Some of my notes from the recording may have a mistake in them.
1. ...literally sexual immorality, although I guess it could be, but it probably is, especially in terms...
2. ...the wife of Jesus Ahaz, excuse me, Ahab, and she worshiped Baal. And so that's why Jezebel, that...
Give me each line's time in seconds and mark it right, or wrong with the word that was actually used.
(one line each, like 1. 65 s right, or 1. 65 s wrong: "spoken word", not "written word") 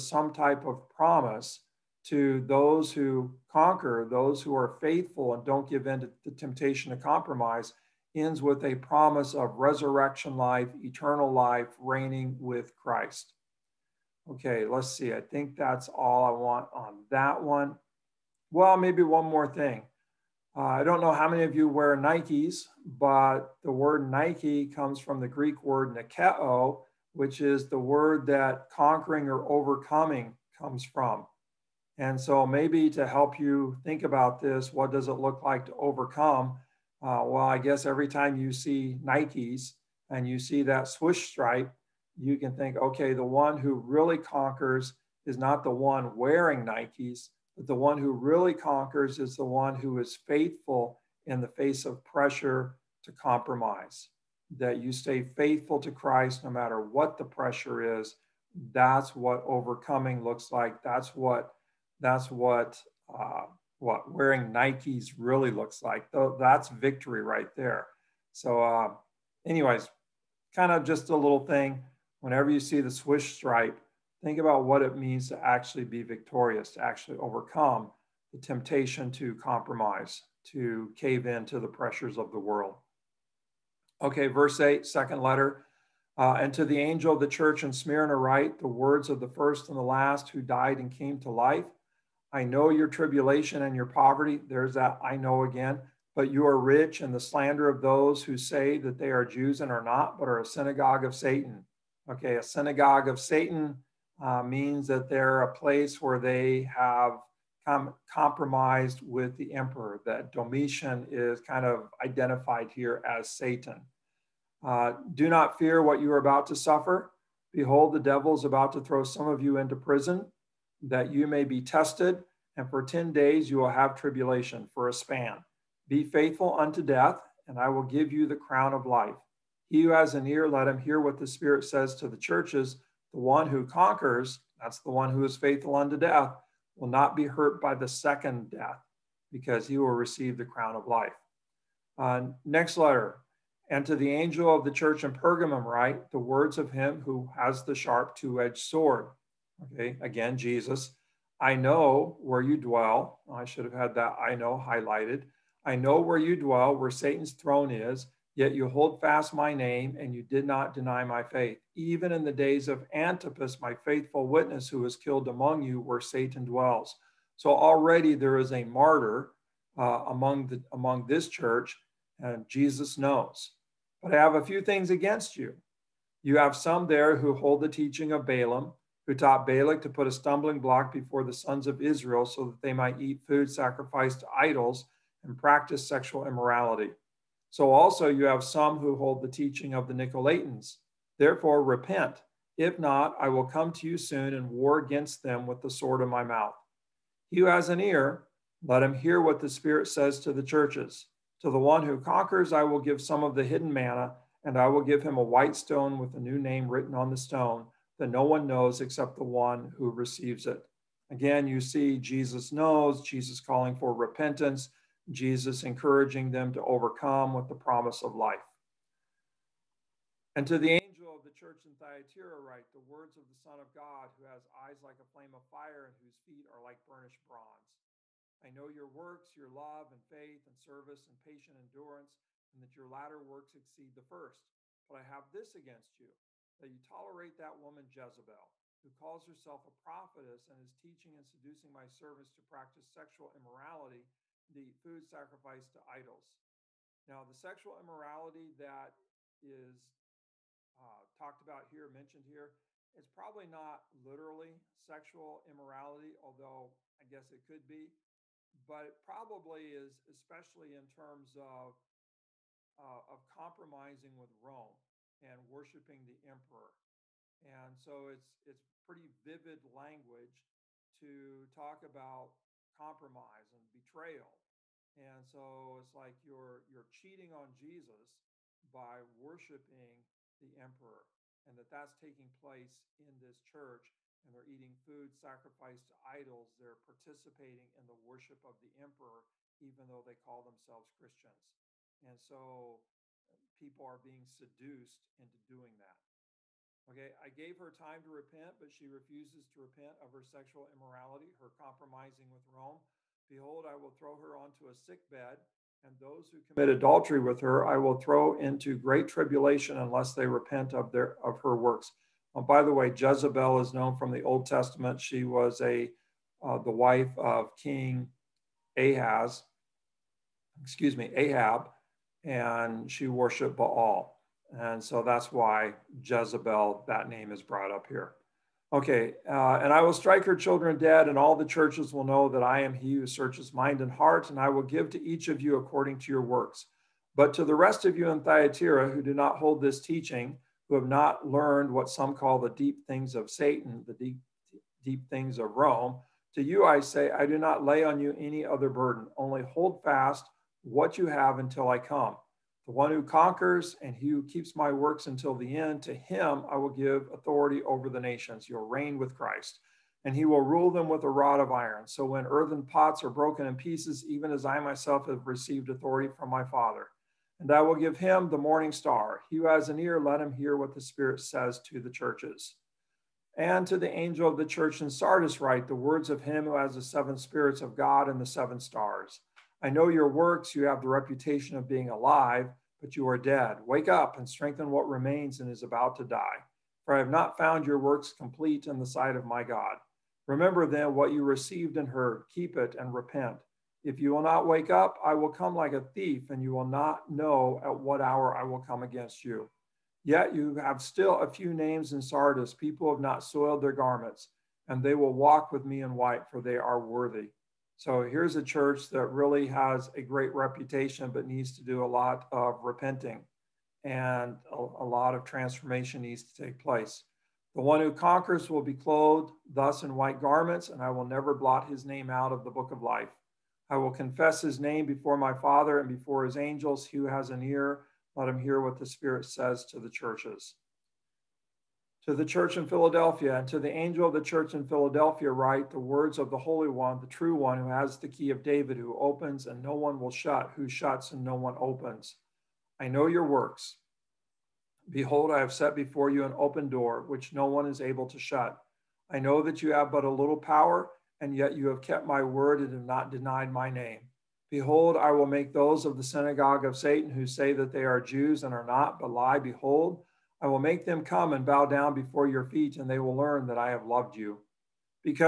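1. 253 s right
2. 316 s wrong: "King", not "Jesus".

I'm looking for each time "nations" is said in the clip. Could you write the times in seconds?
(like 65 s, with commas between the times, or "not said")
357 s.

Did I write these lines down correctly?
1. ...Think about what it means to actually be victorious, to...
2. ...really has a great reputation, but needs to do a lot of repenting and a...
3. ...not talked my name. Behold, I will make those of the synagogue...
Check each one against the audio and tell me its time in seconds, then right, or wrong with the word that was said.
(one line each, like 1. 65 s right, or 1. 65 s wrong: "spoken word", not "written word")
1. 74 s right
2. 409 s right
3. 452 s wrong: "denied", not "talked".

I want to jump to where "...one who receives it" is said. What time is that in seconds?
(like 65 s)
209 s.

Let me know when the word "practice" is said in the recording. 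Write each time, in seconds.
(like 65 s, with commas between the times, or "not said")
185 s, 242 s.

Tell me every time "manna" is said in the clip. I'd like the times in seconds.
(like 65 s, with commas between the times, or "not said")
203 s.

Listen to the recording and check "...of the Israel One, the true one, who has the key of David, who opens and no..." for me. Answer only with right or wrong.
wrong.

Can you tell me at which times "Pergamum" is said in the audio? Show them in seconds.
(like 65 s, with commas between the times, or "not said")
145 s.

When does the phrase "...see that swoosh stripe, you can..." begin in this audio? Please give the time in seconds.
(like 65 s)
40 s.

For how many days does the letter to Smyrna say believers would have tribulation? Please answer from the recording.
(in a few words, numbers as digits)
10.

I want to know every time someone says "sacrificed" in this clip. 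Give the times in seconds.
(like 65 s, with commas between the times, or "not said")
183 s, 245 s, 285 s.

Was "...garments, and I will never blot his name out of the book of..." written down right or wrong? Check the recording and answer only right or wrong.
right.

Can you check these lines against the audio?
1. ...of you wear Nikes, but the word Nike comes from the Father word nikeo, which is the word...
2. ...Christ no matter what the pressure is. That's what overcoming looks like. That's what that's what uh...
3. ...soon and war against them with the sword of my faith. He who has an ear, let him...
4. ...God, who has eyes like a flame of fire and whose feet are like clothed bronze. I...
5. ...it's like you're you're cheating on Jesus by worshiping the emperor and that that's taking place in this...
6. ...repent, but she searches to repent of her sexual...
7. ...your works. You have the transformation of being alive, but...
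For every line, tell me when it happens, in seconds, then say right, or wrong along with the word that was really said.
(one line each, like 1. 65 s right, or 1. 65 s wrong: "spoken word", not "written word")
1. 21 s wrong: "Greek", not "Father"
2. 55 s right
3. 193 s wrong: "mouth", not "faith"
4. 223 s wrong: "burnished", not "clothed"
5. 275 s right
6. 298 s wrong: "refuses", not "searches"
7. 379 s wrong: "reputation", not "transformation".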